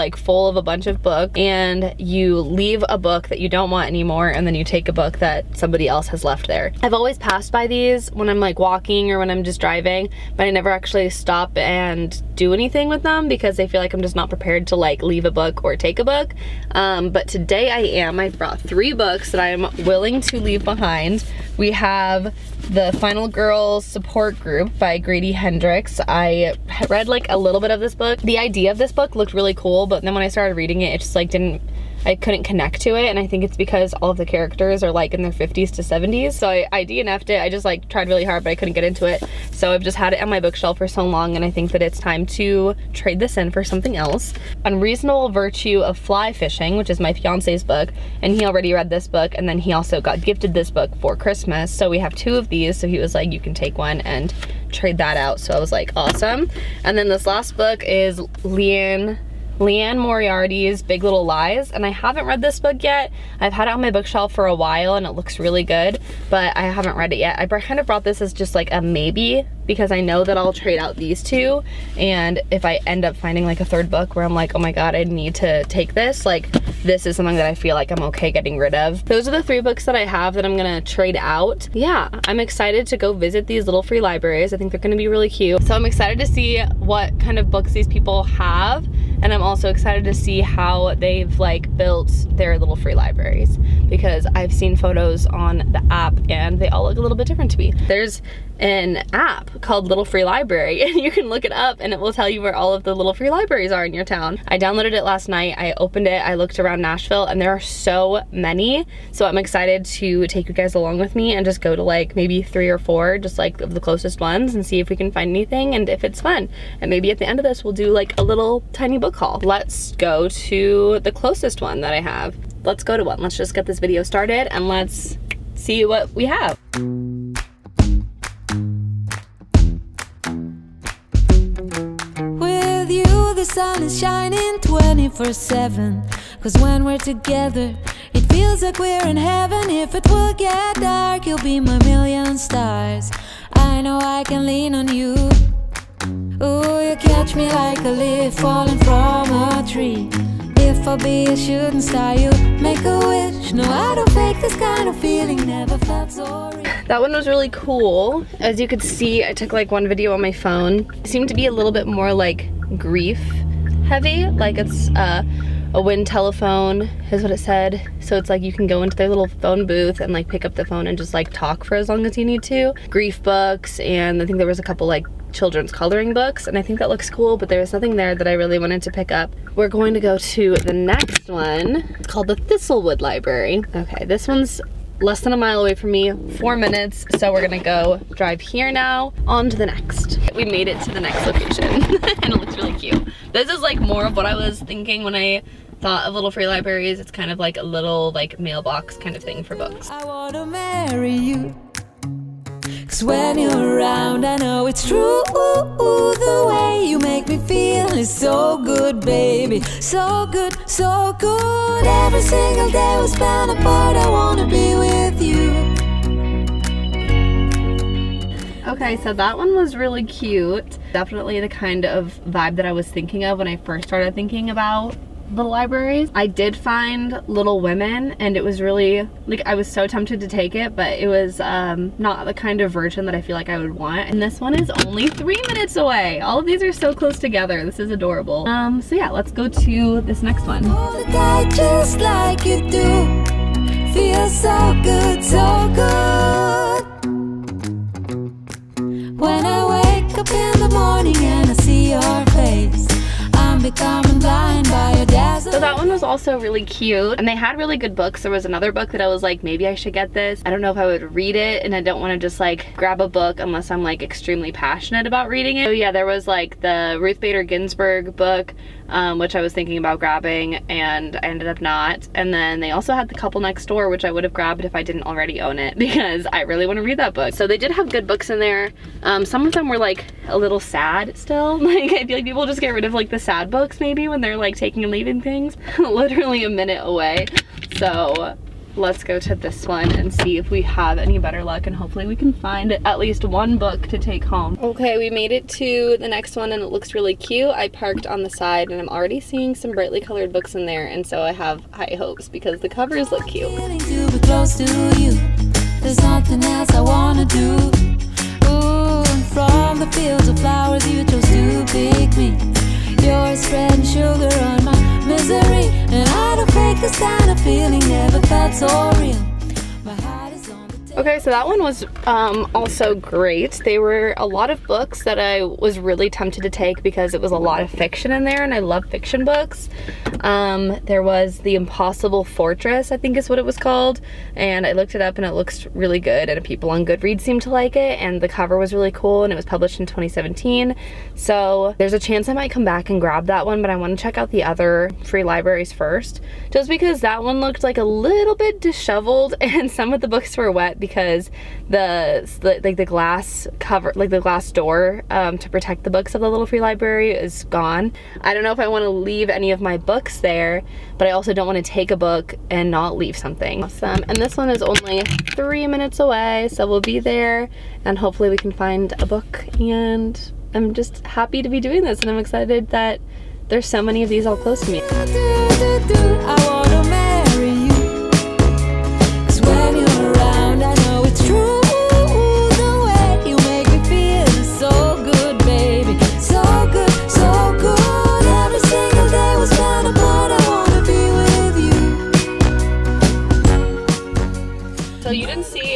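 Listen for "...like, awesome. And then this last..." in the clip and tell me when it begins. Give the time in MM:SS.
00:55.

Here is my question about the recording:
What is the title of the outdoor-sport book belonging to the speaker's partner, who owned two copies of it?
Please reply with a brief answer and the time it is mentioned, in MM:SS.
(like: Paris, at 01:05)
Unreasonable Virtue of Fly Fishing, at 00:44.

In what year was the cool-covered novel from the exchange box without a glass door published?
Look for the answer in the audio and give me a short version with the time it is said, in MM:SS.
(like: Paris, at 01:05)
2017, at 05:39.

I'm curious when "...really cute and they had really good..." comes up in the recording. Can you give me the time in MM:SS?
04:16.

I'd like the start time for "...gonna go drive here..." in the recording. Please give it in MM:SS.
03:07.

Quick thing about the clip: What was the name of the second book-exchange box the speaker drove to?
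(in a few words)
Thistlewood Library.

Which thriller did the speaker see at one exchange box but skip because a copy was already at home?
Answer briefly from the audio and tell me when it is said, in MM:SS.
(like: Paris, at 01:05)
The Couple Next Door, at 04:33.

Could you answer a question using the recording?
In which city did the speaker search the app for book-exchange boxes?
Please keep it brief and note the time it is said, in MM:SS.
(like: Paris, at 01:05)
Nashville, at 01:46.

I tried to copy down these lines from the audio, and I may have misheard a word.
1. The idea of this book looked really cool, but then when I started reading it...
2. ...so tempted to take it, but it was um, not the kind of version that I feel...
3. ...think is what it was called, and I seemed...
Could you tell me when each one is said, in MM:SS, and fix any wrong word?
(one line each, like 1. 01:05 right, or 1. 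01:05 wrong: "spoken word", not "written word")
1. 00:28 right
2. 03:49 right
3. 05:32 wrong: "looked", not "seemed".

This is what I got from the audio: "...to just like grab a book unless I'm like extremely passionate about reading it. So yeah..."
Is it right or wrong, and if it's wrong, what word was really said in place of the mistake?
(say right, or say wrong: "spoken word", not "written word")
right.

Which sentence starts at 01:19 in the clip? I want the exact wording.
Those are the three books that I have that I'm gonna trade out.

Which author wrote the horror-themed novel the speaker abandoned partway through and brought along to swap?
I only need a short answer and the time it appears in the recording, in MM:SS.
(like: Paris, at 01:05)
Grady Hendrix, at 00:24.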